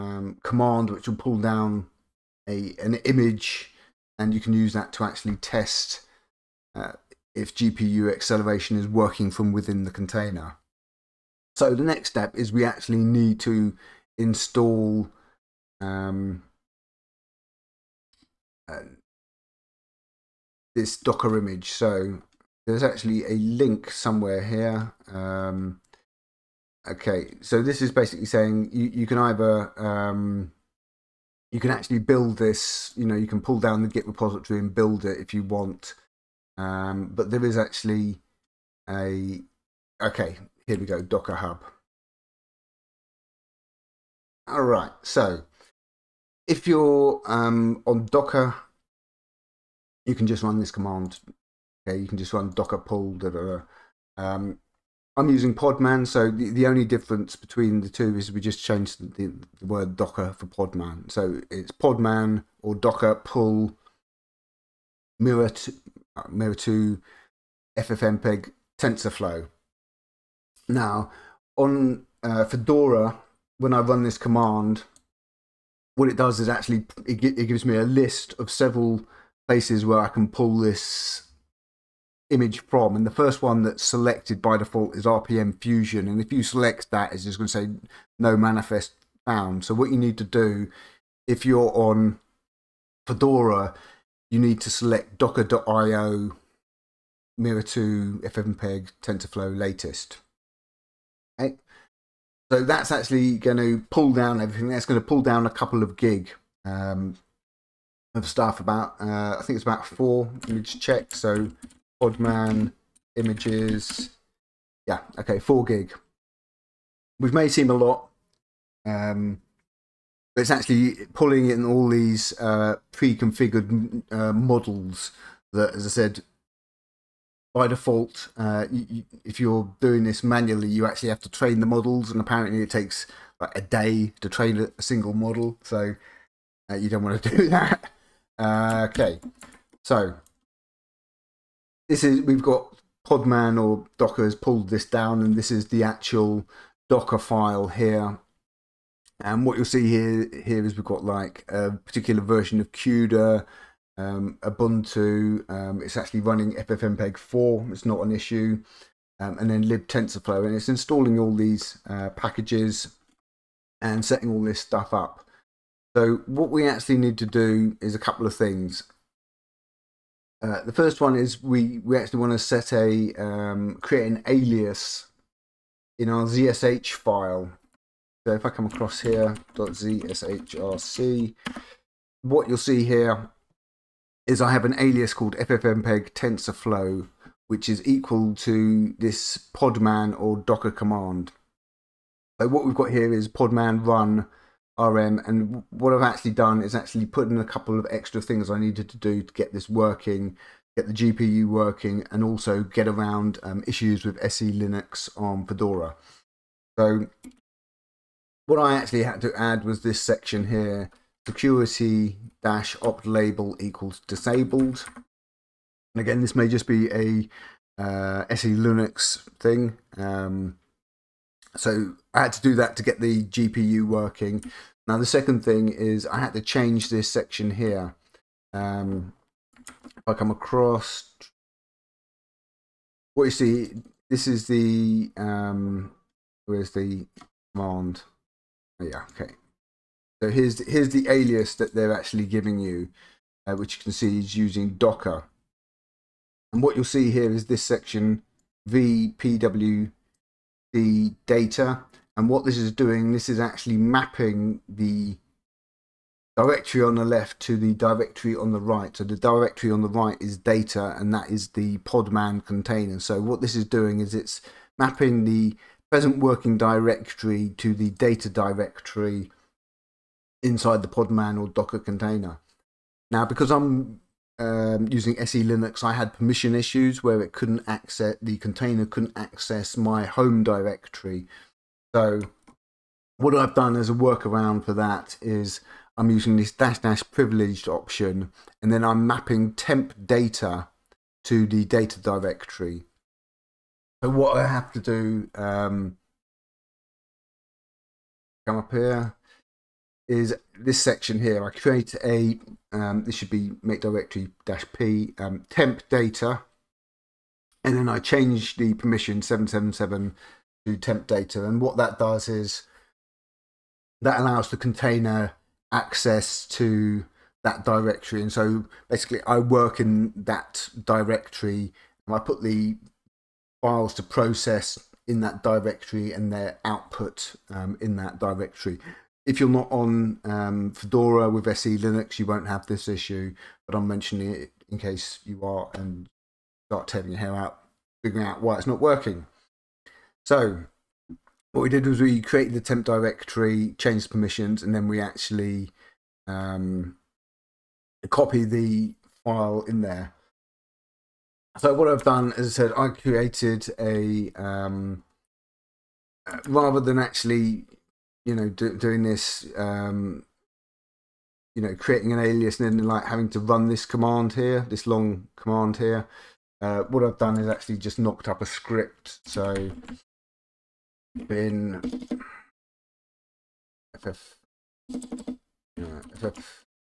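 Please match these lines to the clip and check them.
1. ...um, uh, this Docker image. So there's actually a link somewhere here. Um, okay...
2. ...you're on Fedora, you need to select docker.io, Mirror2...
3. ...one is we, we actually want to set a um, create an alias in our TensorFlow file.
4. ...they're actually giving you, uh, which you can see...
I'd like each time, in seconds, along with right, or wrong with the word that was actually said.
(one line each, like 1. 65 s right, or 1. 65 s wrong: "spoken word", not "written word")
1. 15 s right
2. 91 s right
3. 170 s wrong: "ZSH", not "TensorFlow"
4. 241 s right.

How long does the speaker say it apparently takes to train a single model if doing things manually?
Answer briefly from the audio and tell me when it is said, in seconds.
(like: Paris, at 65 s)
a day, at 133 s.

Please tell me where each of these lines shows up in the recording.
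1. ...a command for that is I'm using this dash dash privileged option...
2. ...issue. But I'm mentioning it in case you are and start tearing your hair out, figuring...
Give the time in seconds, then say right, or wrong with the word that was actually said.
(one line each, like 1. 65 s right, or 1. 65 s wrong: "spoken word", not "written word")
1. 283 s wrong: "workaround", not "command"
2. 332 s right.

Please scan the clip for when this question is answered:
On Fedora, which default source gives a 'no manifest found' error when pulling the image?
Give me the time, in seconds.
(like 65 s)
85 s.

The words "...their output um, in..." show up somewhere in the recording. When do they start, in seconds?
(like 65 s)
326 s.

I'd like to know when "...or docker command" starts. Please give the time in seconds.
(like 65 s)
190 s.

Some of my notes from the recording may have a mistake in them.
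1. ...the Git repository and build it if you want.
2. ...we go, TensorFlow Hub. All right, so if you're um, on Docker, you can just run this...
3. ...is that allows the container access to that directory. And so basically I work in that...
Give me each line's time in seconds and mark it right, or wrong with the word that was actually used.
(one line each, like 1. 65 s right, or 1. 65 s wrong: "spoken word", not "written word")
1. 33 s right
2. 40 s wrong: "Docker", not "TensorFlow"
3. 312 s right.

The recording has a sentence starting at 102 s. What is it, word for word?
So that's actually going to pull down everything.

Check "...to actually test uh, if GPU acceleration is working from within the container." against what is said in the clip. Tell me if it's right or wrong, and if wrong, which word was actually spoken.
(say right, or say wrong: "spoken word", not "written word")
right.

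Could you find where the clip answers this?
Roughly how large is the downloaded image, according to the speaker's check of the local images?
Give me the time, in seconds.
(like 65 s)
115 s.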